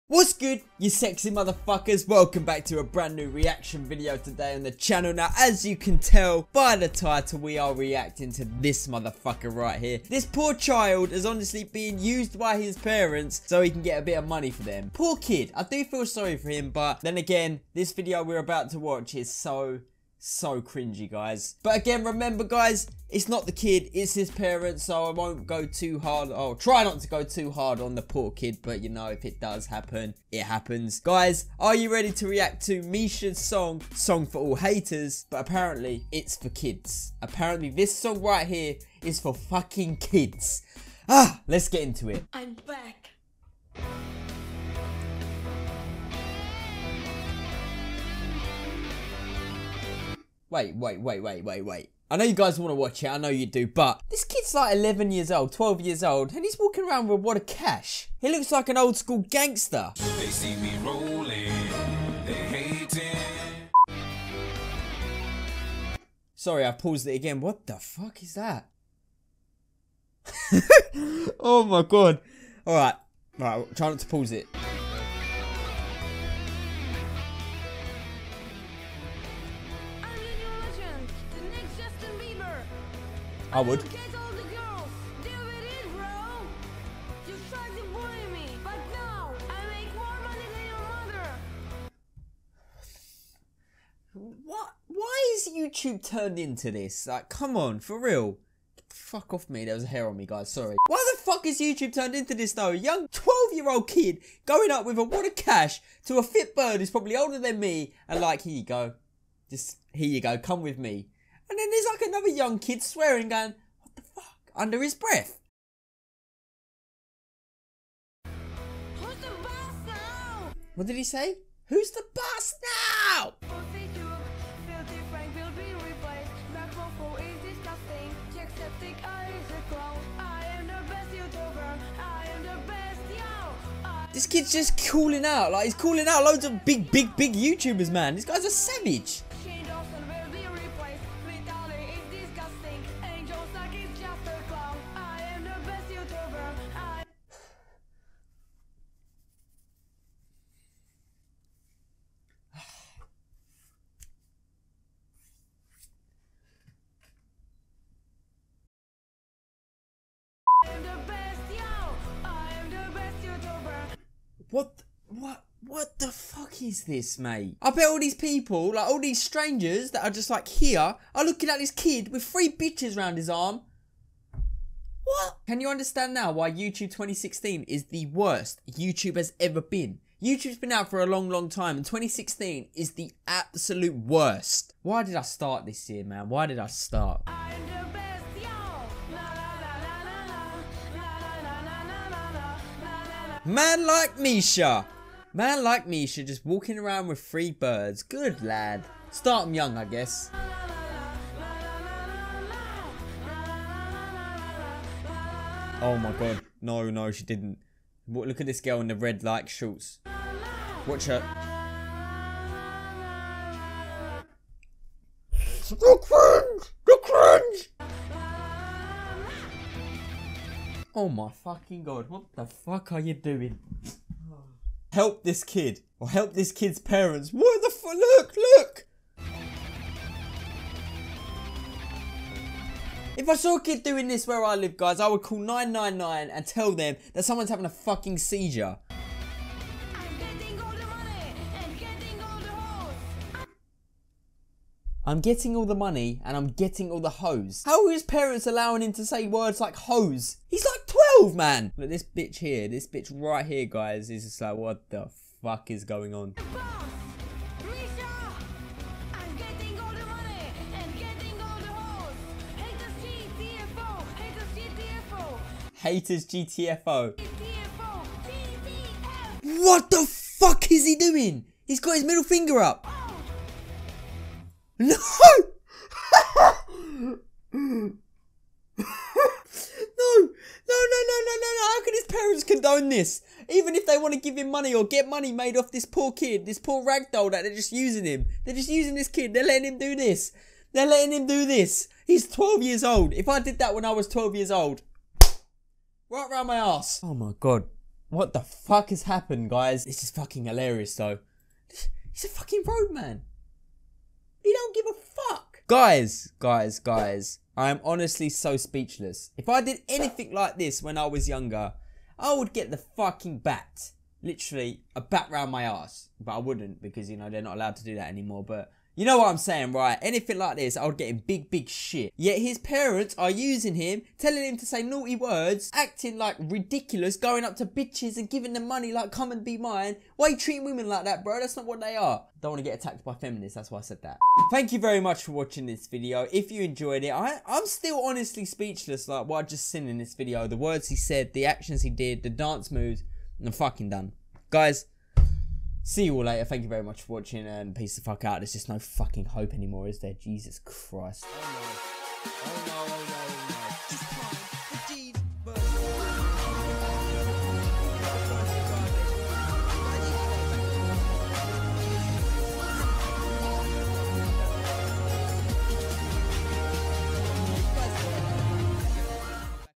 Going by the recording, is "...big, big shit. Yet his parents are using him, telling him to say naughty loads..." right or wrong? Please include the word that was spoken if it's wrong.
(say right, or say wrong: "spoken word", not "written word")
wrong: "words", not "loads".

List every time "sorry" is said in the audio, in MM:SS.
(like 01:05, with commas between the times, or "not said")
00:16, 01:06, 01:40.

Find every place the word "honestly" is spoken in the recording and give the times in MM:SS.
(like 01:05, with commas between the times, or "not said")
00:11, 05:07, 05:38.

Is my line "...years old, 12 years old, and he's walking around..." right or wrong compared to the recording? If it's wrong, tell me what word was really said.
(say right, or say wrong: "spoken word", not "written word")
right.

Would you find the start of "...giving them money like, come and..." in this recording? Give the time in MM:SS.
05:28.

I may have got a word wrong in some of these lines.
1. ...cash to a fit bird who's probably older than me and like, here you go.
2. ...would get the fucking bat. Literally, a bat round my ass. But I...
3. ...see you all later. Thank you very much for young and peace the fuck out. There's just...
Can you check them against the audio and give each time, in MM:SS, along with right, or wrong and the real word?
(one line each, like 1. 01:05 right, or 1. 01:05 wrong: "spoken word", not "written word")
1. 01:45 right
2. 05:12 right
3. 05:45 wrong: "watching", not "young".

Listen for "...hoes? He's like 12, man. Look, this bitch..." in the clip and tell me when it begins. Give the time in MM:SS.
04:09.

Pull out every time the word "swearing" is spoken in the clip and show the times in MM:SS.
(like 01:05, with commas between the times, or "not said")
01:52.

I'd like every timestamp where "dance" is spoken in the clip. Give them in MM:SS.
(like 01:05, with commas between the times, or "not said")
05:42.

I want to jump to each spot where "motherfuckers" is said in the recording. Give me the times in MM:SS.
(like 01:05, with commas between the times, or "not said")
00:01, 00:08.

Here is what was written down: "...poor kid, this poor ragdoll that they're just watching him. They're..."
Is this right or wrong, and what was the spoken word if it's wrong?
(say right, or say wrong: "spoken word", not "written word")
wrong: "using", not "watching".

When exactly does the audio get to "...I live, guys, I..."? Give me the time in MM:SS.
03:54.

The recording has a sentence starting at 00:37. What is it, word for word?
Apparently, this song right here is for fucking kids.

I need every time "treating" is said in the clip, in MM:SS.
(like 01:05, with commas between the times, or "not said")
05:30.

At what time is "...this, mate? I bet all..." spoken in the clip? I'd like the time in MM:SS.
02:46.